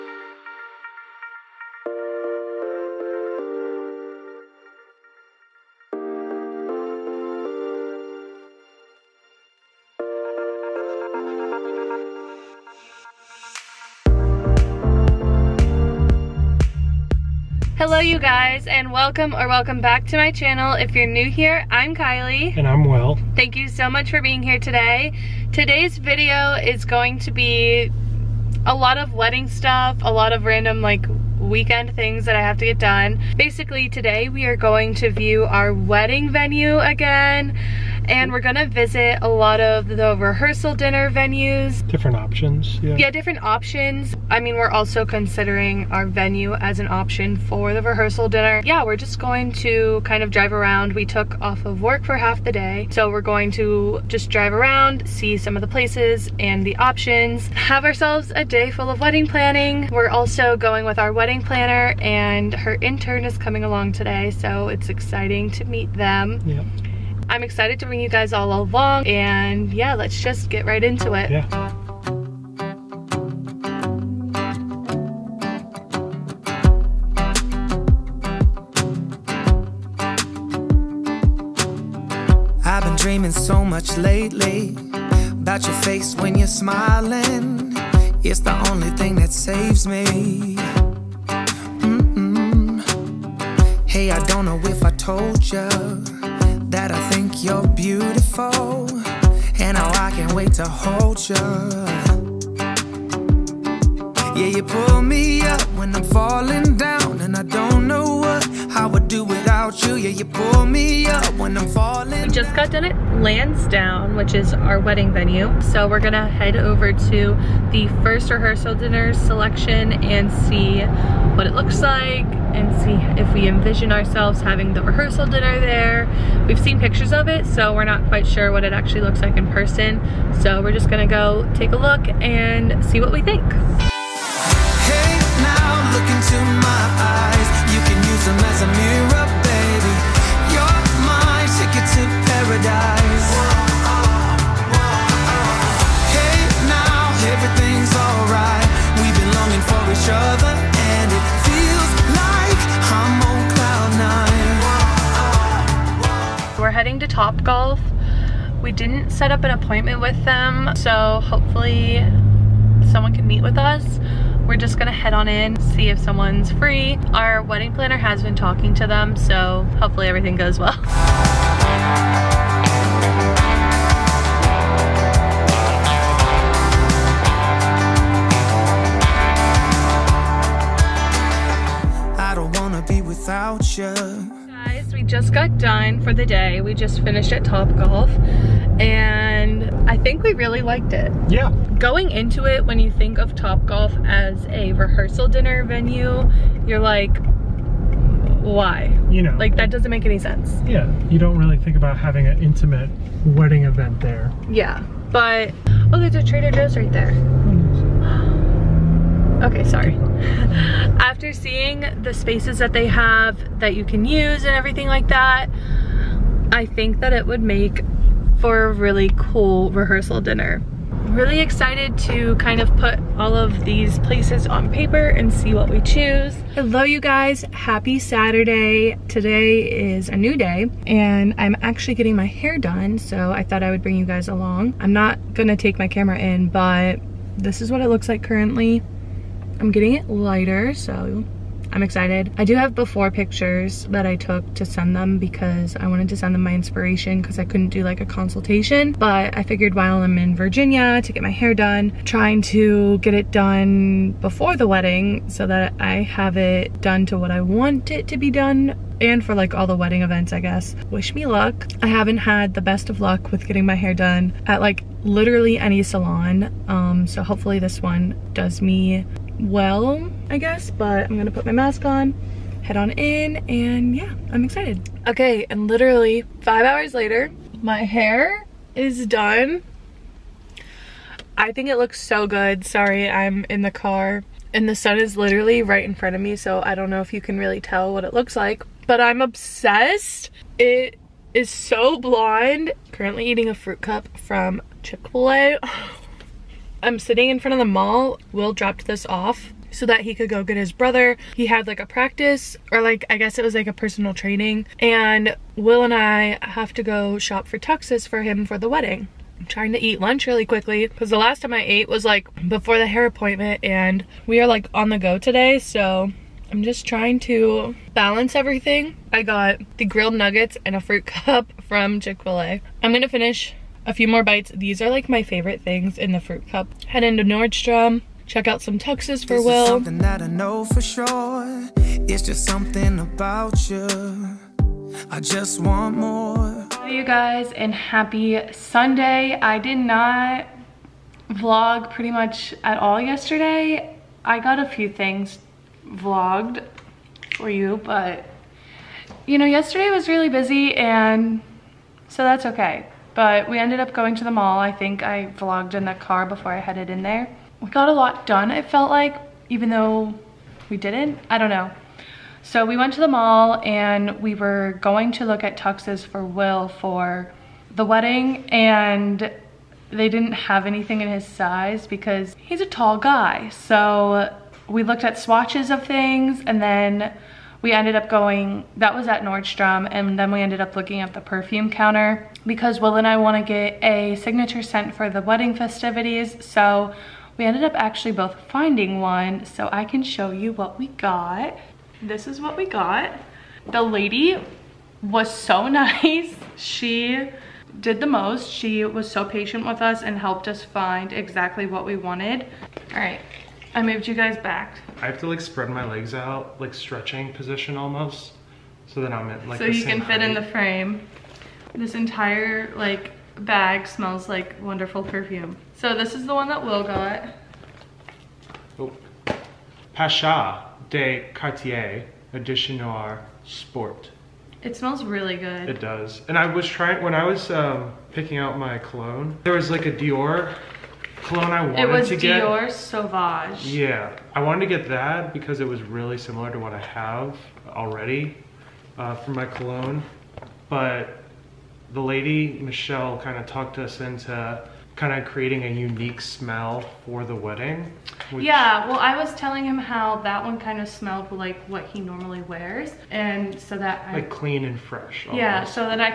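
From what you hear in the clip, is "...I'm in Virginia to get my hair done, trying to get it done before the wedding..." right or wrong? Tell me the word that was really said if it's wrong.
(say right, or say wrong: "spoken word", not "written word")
right.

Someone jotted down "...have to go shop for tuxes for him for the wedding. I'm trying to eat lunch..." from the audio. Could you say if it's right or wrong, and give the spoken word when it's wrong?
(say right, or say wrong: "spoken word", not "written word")
right.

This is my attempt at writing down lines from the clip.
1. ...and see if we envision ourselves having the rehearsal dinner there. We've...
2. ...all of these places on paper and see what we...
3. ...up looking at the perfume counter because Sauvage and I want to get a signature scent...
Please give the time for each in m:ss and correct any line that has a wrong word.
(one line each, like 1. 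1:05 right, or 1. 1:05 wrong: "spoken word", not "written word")
1. 2:02 right
2. 3:43 right
3. 6:20 wrong: "Will", not "Sauvage".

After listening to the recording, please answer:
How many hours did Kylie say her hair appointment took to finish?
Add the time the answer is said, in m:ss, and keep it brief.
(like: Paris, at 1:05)
5, at 4:36.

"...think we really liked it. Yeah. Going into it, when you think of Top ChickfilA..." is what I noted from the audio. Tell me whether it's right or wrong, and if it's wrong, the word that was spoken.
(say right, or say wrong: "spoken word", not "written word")
wrong: "Golf", not "ChickfilA".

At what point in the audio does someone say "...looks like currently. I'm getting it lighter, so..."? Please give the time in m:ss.
3:57.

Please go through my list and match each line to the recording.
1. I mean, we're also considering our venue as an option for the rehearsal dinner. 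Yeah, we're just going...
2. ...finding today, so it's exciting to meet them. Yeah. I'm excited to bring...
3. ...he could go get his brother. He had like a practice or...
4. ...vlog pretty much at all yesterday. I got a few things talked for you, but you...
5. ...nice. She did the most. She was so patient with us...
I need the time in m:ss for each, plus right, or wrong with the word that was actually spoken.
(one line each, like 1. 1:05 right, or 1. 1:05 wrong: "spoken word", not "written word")
1. 0:44 right
2. 1:03 wrong: "along", not "finding"
3. 5:00 right
4. 5:41 wrong: "vlogged", not "talked"
5. 6:35 right.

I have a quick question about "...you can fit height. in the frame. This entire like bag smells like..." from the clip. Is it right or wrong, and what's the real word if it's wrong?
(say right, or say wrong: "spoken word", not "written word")
right.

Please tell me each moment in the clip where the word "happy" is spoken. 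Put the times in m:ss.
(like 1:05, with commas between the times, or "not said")
3:47, 5:37.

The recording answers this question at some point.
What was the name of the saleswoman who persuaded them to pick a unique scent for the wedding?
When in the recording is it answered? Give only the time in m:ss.
7:22.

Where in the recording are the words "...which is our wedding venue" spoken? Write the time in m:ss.
1:54.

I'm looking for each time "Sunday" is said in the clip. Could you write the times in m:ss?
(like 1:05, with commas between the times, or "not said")
5:38.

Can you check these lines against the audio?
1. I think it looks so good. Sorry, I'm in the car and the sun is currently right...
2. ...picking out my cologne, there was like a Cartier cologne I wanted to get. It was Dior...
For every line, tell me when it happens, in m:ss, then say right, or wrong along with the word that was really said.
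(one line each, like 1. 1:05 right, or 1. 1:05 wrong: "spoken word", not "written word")
1. 4:41 wrong: "literally", not "currently"
2. 7:08 wrong: "Dior", not "Cartier".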